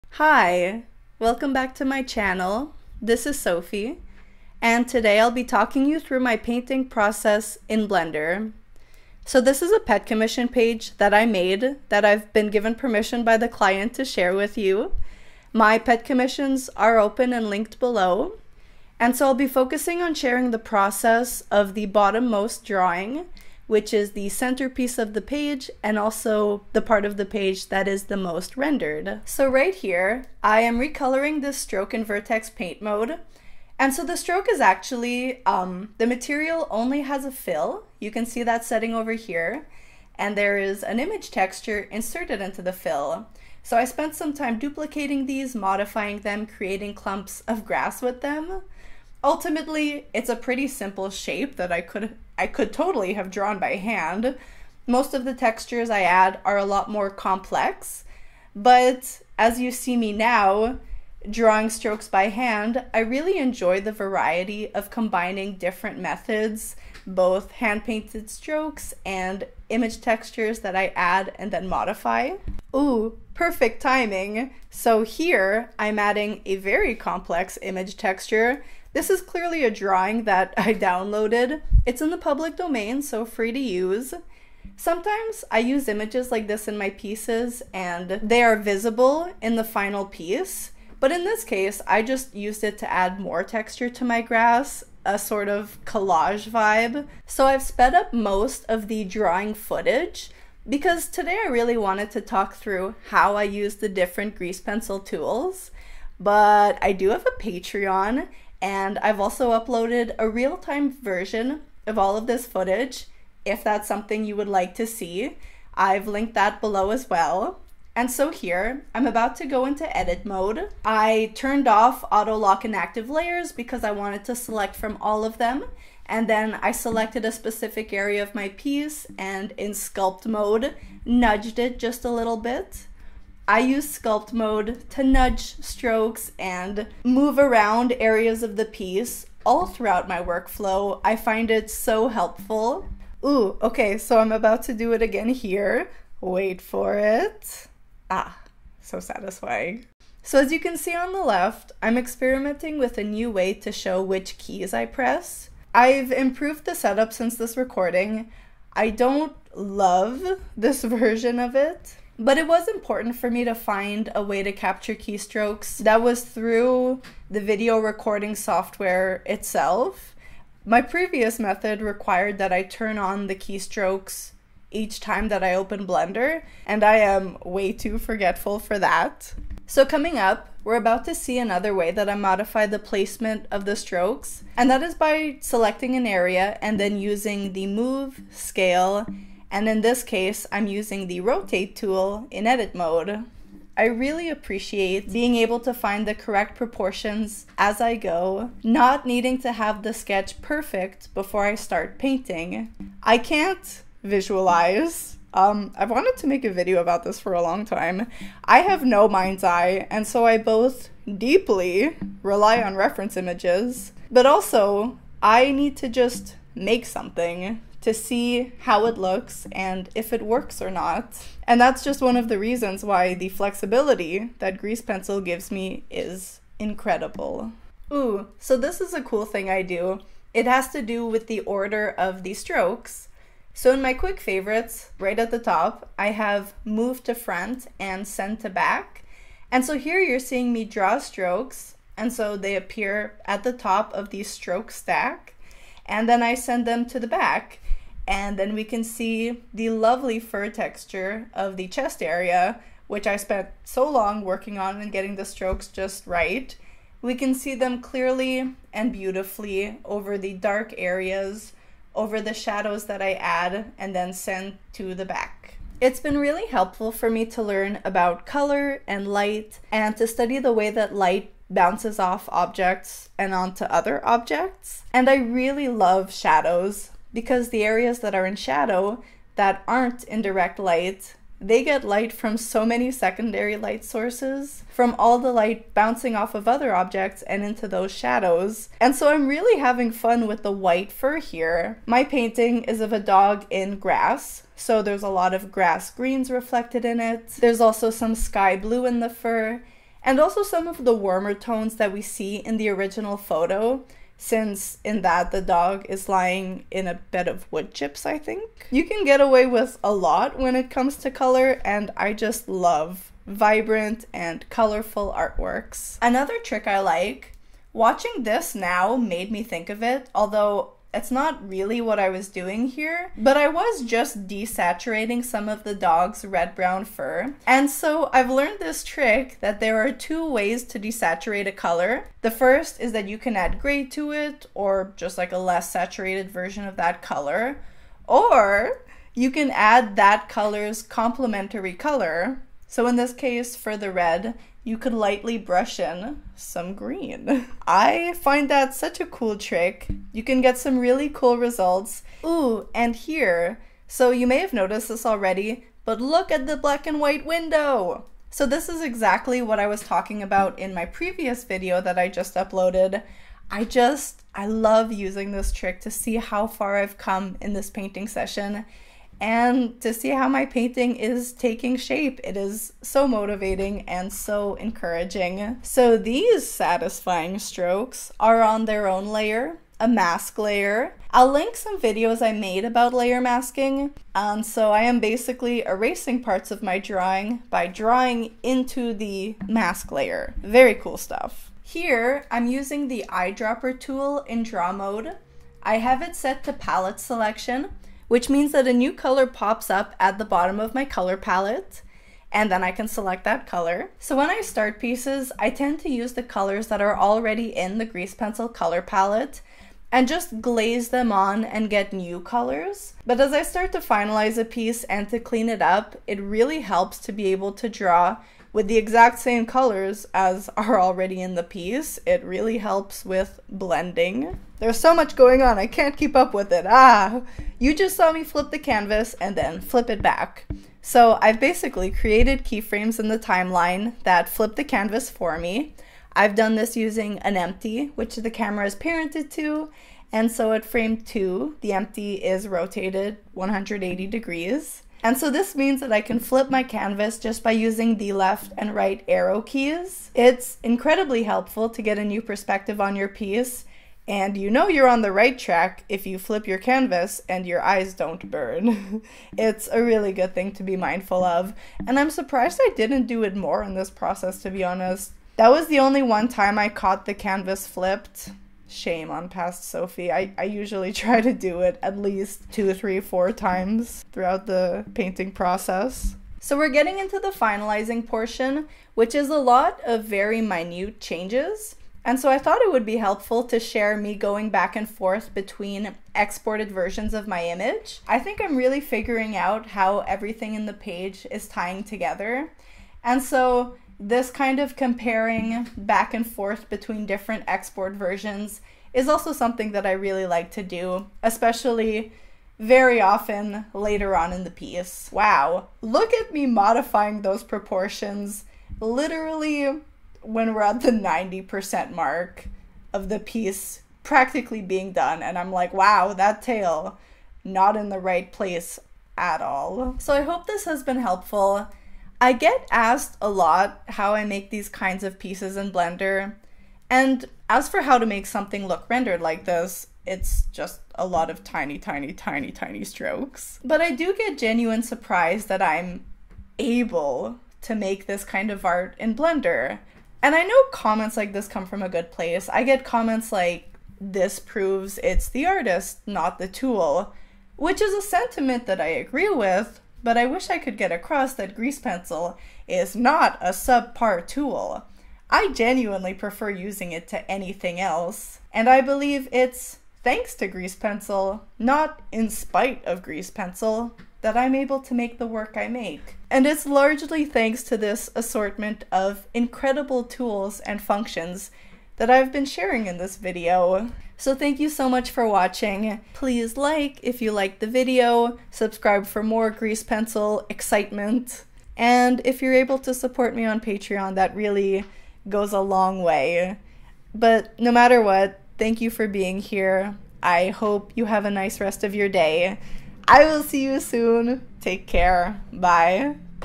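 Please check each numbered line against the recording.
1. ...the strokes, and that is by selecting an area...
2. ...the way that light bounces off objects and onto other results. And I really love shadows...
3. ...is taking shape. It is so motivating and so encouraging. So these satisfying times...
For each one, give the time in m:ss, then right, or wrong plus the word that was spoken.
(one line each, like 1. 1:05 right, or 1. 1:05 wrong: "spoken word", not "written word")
1. 3:03 right
2. 4:30 wrong: "objects", not "results"
3. 6:10 wrong: "strokes", not "times".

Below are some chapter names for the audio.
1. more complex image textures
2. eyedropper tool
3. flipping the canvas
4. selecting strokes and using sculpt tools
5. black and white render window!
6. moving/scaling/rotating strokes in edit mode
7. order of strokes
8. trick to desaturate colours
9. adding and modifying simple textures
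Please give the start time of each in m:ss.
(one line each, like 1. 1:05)
1. 1:12
2. 6:31
3. 7:05
4. 1:58
5. 5:52
6. 2:59
7. 3:47
8. 5:15
9. 0:28.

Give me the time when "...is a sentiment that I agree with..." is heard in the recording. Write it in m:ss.
9:07.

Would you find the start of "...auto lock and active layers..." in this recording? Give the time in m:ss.
2:02.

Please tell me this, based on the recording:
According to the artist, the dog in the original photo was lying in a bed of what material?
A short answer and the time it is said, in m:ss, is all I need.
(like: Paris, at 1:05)
Wood chips, at 5:07.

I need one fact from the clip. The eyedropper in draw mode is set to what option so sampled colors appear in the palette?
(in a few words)
Palette selection.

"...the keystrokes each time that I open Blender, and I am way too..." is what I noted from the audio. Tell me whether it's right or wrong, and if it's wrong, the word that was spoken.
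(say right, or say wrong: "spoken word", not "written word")
right.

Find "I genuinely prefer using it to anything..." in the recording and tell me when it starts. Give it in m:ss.
9:15.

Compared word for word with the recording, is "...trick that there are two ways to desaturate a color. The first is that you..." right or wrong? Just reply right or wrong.
right.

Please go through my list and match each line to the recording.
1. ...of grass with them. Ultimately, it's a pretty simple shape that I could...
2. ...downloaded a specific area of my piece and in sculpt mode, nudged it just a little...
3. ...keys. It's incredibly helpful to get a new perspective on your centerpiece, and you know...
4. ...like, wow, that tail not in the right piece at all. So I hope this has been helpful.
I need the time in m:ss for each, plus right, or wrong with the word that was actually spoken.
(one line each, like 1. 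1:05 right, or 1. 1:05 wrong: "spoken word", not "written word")
1. 0:47 right
2. 2:06 wrong: "selected", not "downloaded"
3. 7:29 wrong: "piece", not "centerpiece"
4. 8:35 wrong: "place", not "piece".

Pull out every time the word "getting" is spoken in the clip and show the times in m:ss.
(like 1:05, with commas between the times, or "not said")
4:14, 7:56.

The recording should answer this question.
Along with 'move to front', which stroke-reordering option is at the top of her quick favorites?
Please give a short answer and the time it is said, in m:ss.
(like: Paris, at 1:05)
Send to back, at 3:58.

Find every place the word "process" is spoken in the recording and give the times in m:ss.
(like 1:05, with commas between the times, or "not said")
0:06, 0:20, 7:43, 7:55.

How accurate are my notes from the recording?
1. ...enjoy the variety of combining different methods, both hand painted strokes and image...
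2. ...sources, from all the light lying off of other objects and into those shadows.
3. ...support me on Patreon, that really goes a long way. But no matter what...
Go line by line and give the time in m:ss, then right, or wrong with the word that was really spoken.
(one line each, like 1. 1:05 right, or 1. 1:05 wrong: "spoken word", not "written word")
1. 1:03 right
2. 4:43 wrong: "bouncing", not "lying"
3. 9:42 right.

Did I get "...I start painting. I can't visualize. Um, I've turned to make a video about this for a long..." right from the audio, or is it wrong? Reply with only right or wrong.
wrong.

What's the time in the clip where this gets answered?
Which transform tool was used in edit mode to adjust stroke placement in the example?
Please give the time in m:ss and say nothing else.
3:11.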